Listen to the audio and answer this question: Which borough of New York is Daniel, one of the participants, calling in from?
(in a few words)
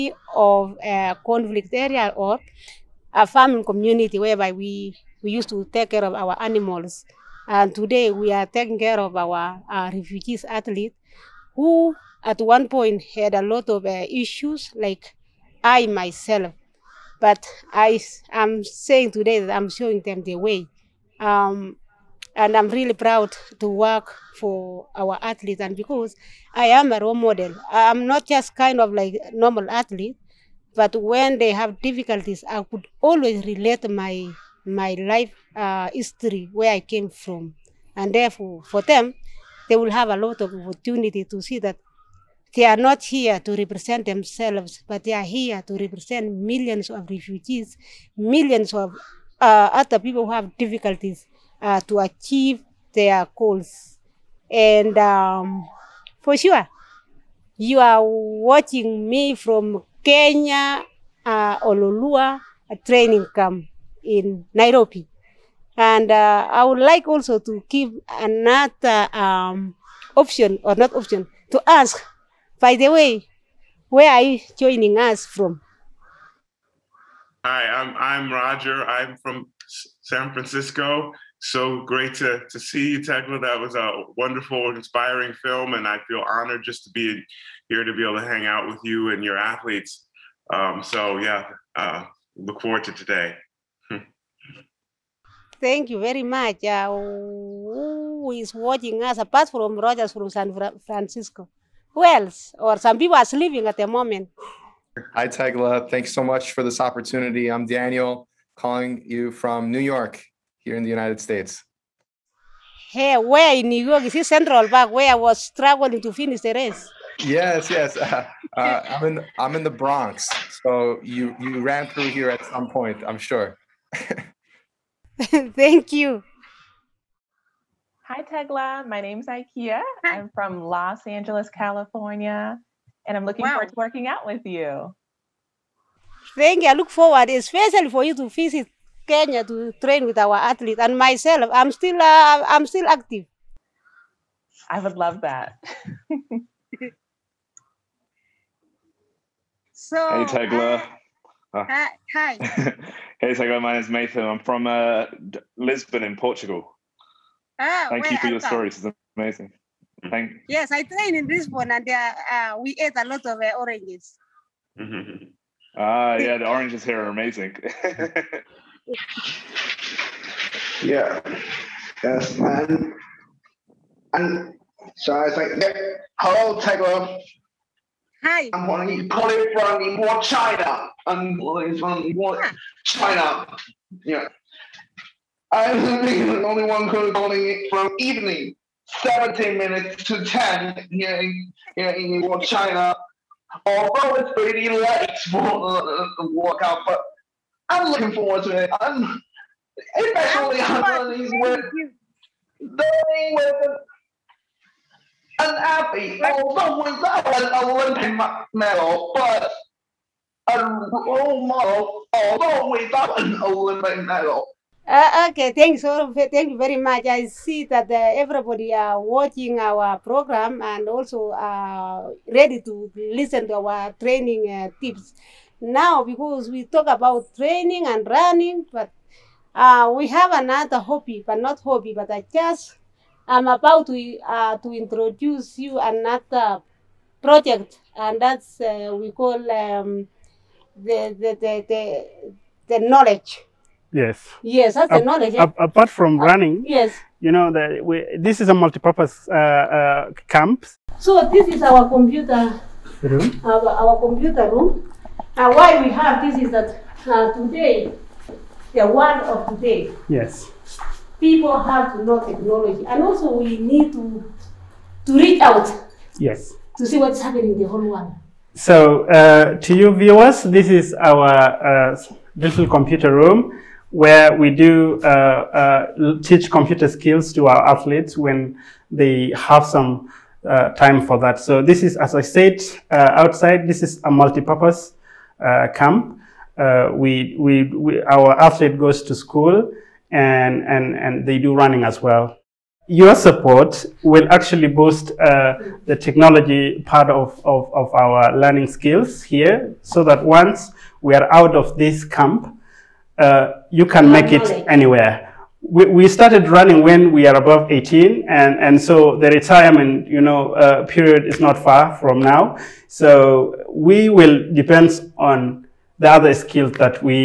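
The Bronx.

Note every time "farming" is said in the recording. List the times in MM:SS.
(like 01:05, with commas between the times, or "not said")
00:03.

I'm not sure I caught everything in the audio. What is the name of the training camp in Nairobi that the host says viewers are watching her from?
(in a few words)
Ololua.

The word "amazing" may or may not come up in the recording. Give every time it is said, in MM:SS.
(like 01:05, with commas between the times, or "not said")
02:39, 02:47.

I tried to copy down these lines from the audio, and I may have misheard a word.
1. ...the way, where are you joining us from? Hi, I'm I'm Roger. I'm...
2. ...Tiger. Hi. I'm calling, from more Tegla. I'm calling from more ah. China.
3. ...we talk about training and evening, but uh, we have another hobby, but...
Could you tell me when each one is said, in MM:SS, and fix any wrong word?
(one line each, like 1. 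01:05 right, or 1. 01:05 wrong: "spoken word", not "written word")
1. 01:12 right
2. 02:56 wrong: "China", not "Tegla"
3. 03:46 wrong: "running", not "evening".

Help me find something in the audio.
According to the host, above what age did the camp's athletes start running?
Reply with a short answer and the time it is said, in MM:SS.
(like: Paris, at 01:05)
18, at 05:07.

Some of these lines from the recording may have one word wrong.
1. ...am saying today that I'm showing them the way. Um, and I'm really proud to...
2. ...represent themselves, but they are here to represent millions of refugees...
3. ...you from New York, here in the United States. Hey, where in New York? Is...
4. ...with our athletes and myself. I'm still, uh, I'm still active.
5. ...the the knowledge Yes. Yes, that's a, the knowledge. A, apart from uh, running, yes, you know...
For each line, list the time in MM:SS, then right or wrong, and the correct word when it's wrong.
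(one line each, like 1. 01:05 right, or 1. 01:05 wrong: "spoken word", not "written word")
1. 00:18 right
2. 00:43 right
3. 01:49 right
4. 02:20 right
5. 04:01 right.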